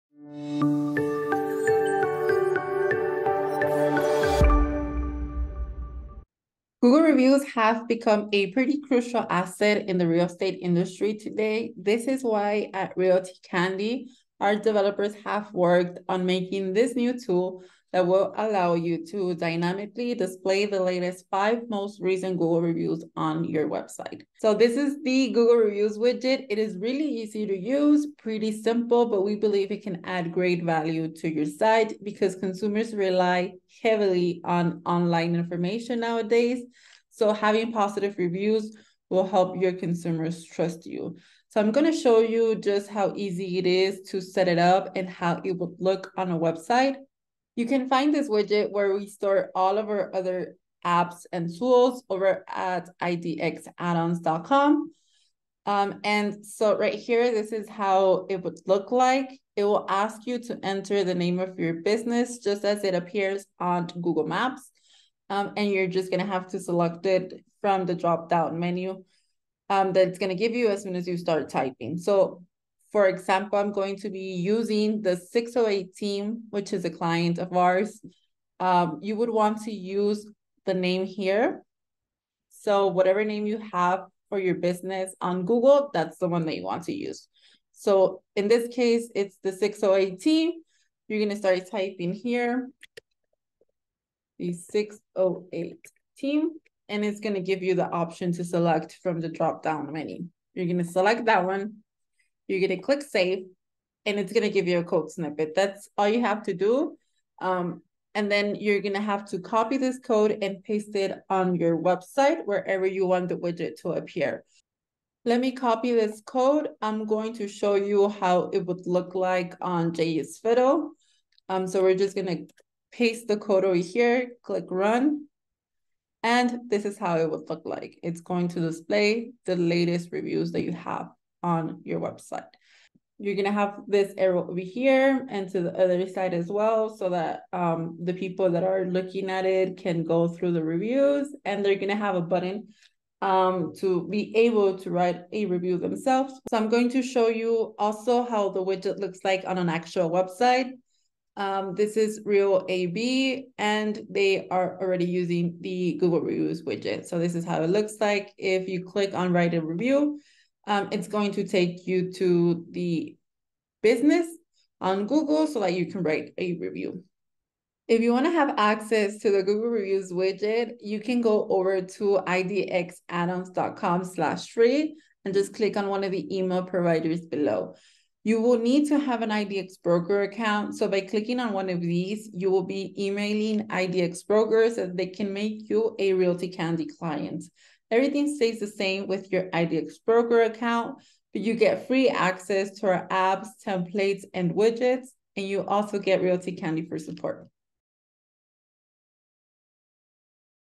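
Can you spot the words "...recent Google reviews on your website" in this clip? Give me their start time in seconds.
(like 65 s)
21 s.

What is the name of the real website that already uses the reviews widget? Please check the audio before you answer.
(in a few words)
Real AB.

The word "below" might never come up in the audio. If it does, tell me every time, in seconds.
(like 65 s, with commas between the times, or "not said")
177 s.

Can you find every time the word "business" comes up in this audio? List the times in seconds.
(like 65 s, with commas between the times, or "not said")
61 s, 84 s, 163 s.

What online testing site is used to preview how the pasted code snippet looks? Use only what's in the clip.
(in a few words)
JS Fiddle.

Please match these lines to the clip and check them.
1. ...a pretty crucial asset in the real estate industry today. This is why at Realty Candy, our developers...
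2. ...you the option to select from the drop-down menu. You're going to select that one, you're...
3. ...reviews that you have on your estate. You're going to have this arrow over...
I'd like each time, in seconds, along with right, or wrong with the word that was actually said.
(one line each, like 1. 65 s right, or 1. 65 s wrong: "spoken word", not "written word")
1. 8 s right
2. 97 s right
3. 130 s wrong: "website", not "estate".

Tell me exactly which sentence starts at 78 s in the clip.
Um, you would want to use the name here.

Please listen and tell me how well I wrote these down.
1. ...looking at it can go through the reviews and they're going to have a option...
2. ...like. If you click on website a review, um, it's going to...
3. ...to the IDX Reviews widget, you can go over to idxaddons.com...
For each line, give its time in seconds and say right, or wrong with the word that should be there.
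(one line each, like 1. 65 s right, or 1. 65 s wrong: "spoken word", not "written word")
1. 138 s wrong: "button", not "option"
2. 158 s wrong: "write", not "website"
3. 169 s wrong: "Google", not "IDX".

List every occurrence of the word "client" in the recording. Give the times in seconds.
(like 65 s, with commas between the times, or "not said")
76 s, 186 s.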